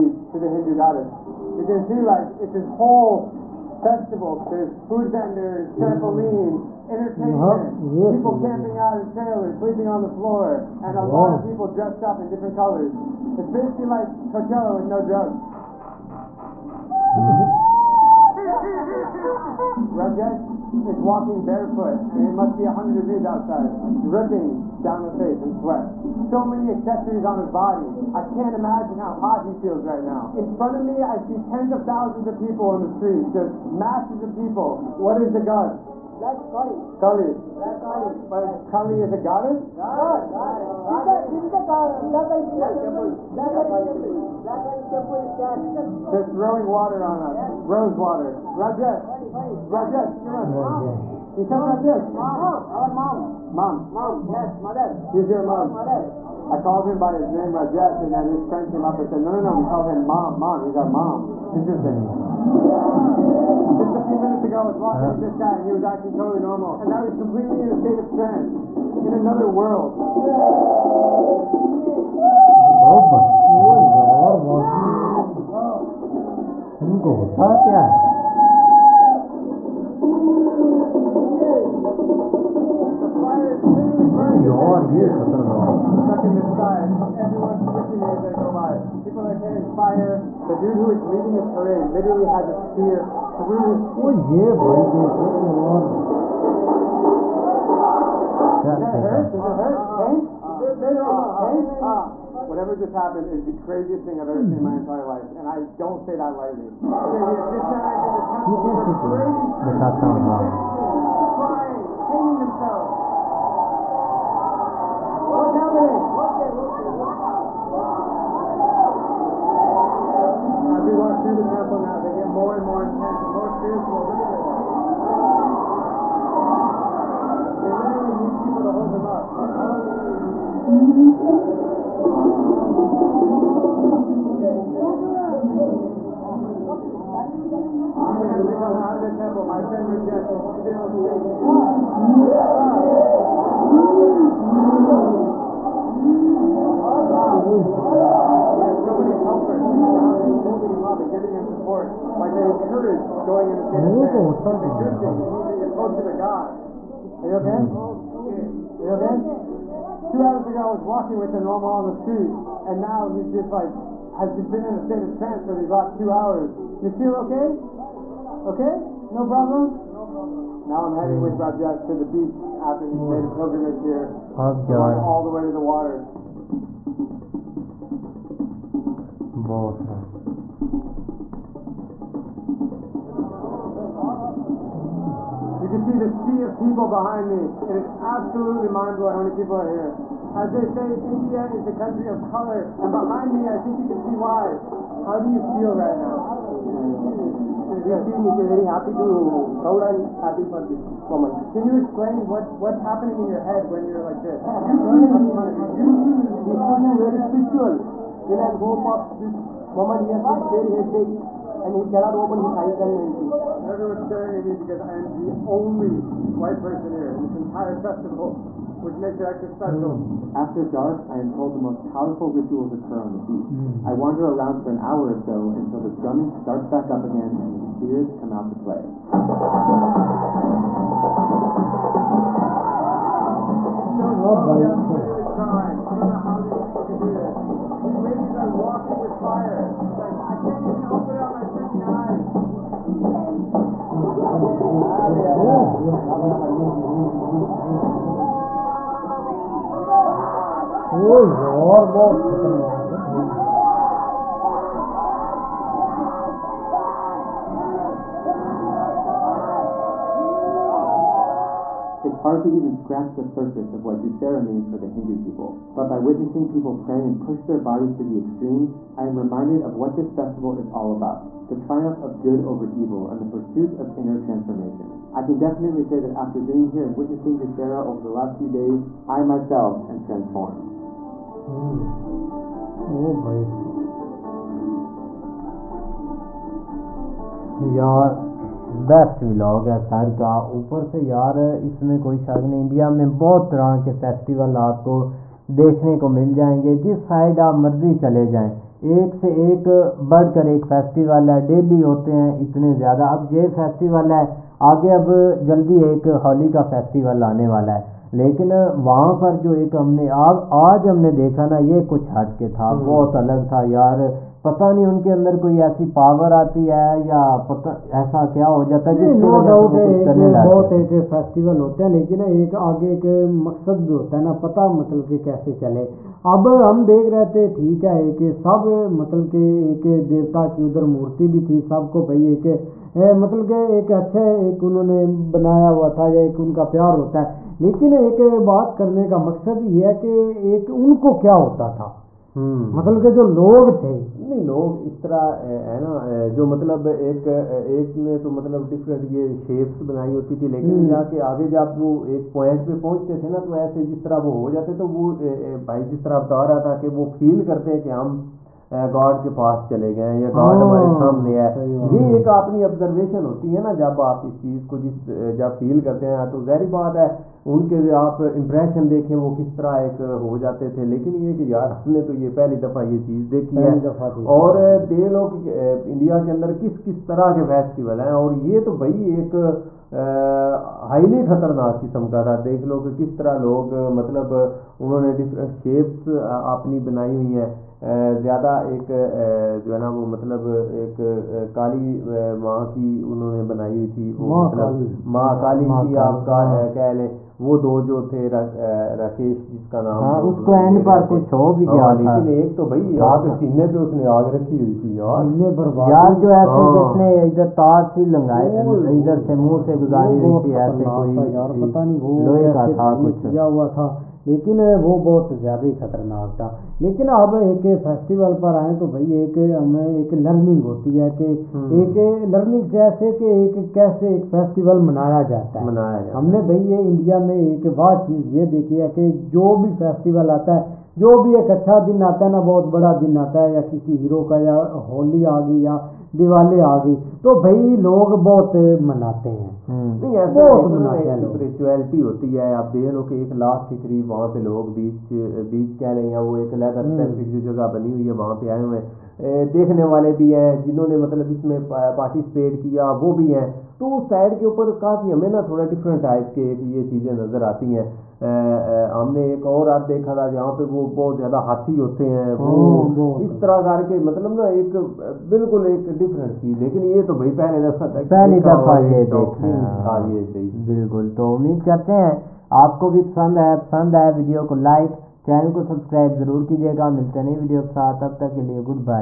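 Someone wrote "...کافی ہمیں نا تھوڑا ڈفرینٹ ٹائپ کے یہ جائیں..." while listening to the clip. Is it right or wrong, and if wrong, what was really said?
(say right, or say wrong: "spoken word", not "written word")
wrong: "چیزیں", not "جائیں".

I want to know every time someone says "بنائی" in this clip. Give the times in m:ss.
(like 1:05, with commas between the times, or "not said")
5:49, 6:26, 6:33.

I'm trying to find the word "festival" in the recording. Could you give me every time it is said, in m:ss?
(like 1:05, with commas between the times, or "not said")
0:03, 3:37, 4:30.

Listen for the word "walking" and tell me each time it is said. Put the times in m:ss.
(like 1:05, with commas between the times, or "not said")
0:20, 1:04, 2:40, 3:58.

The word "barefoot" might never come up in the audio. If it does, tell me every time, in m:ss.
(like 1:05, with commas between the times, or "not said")
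0:21.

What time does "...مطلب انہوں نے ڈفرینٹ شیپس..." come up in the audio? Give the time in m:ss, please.
6:23.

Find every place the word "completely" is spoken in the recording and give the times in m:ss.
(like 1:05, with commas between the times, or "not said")
1:07.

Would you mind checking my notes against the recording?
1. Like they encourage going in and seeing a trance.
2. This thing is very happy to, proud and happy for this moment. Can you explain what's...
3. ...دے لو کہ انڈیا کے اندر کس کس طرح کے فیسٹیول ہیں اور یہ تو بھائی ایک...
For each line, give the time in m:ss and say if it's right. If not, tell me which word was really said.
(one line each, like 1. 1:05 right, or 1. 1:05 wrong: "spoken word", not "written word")
1. 2:32 right
2. 3:17 right
3. 6:14 right.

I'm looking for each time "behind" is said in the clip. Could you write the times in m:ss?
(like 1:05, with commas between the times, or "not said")
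3:06, 3:12.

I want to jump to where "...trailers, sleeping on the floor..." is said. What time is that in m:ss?
0:09.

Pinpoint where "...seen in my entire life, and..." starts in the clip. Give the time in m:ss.
1:44.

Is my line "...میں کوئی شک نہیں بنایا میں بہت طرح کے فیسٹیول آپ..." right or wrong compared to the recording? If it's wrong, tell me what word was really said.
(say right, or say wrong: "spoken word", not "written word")
wrong: "انڈیا", not "بنایا".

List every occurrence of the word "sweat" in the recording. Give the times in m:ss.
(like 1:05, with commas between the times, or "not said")
0:25.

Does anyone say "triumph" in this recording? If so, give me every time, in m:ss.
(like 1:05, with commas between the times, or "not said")
4:31.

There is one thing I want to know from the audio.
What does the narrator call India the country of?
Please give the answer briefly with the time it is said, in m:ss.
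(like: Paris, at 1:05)
Color, at 3:12.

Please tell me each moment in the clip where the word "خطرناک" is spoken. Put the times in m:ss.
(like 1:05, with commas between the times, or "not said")
6:21, 6:55.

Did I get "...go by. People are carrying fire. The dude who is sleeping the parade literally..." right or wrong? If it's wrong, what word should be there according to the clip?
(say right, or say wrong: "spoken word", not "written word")
wrong: "leading", not "sleeping".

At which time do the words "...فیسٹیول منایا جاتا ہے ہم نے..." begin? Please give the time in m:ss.
7:04.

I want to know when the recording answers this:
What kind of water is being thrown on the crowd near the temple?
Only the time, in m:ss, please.
0:47.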